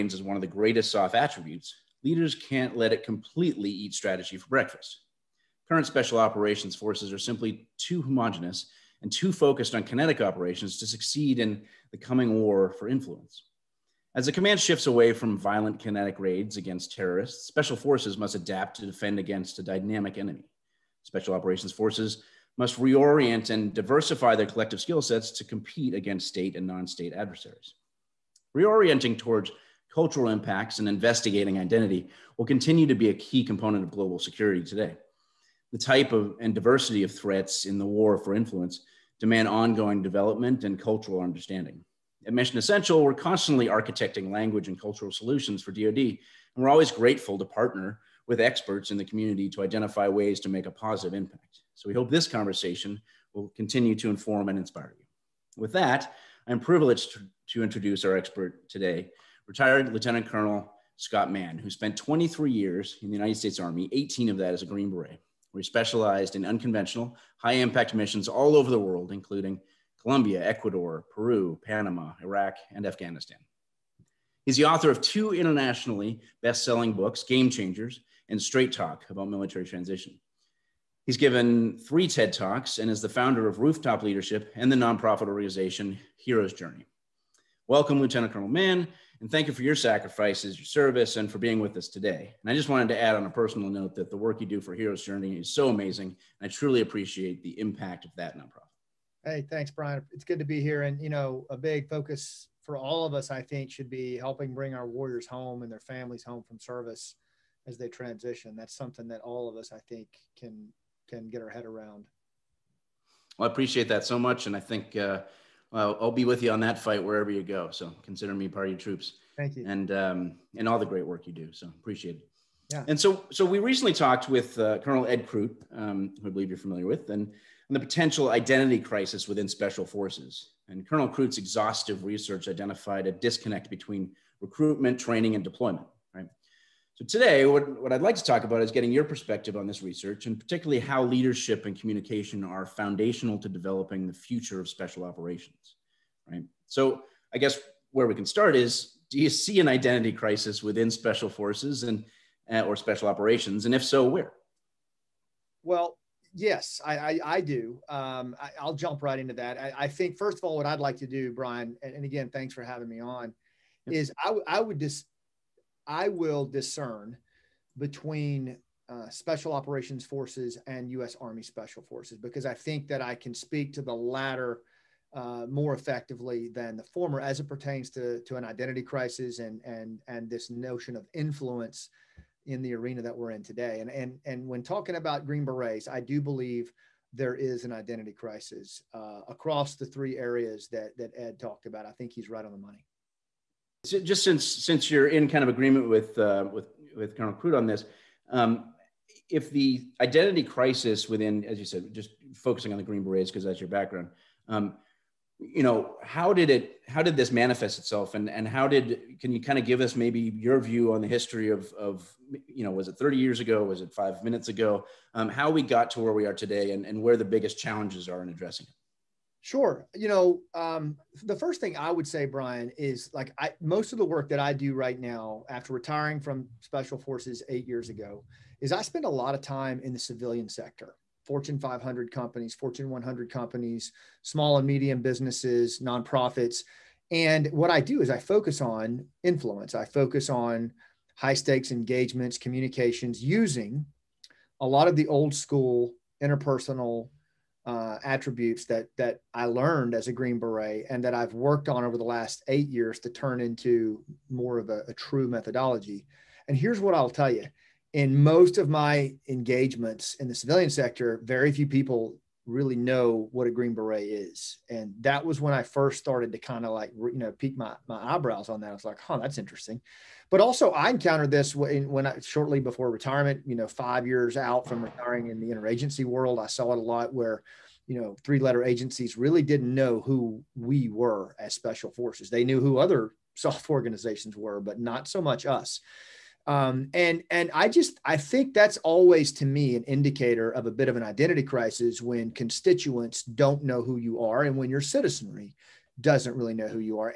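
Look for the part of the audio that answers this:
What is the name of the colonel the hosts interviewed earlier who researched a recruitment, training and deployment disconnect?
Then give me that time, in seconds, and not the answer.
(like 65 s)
125 s.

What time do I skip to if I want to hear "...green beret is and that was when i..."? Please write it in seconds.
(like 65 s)
263 s.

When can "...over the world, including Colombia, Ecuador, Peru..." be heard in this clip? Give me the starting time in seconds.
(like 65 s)
68 s.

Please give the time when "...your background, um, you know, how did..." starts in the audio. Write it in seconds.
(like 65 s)
203 s.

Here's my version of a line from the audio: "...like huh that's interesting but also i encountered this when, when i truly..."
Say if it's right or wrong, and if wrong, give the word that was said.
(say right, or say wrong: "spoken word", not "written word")
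wrong: "shortly", not "truly".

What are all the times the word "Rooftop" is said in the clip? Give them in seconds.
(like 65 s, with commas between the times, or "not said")
83 s.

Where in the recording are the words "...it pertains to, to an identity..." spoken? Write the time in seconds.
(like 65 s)
177 s.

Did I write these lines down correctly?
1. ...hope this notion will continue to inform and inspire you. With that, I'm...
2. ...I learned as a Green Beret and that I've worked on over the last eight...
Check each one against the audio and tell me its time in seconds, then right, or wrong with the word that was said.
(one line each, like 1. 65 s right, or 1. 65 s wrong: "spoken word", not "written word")
1. 51 s wrong: "conversation", not "notion"
2. 249 s right.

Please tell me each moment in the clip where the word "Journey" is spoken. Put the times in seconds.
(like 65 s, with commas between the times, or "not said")
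86 s, 95 s.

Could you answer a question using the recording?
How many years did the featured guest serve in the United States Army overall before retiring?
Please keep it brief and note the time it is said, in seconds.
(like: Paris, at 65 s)
23, at 61 s.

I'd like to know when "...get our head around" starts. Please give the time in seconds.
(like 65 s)
111 s.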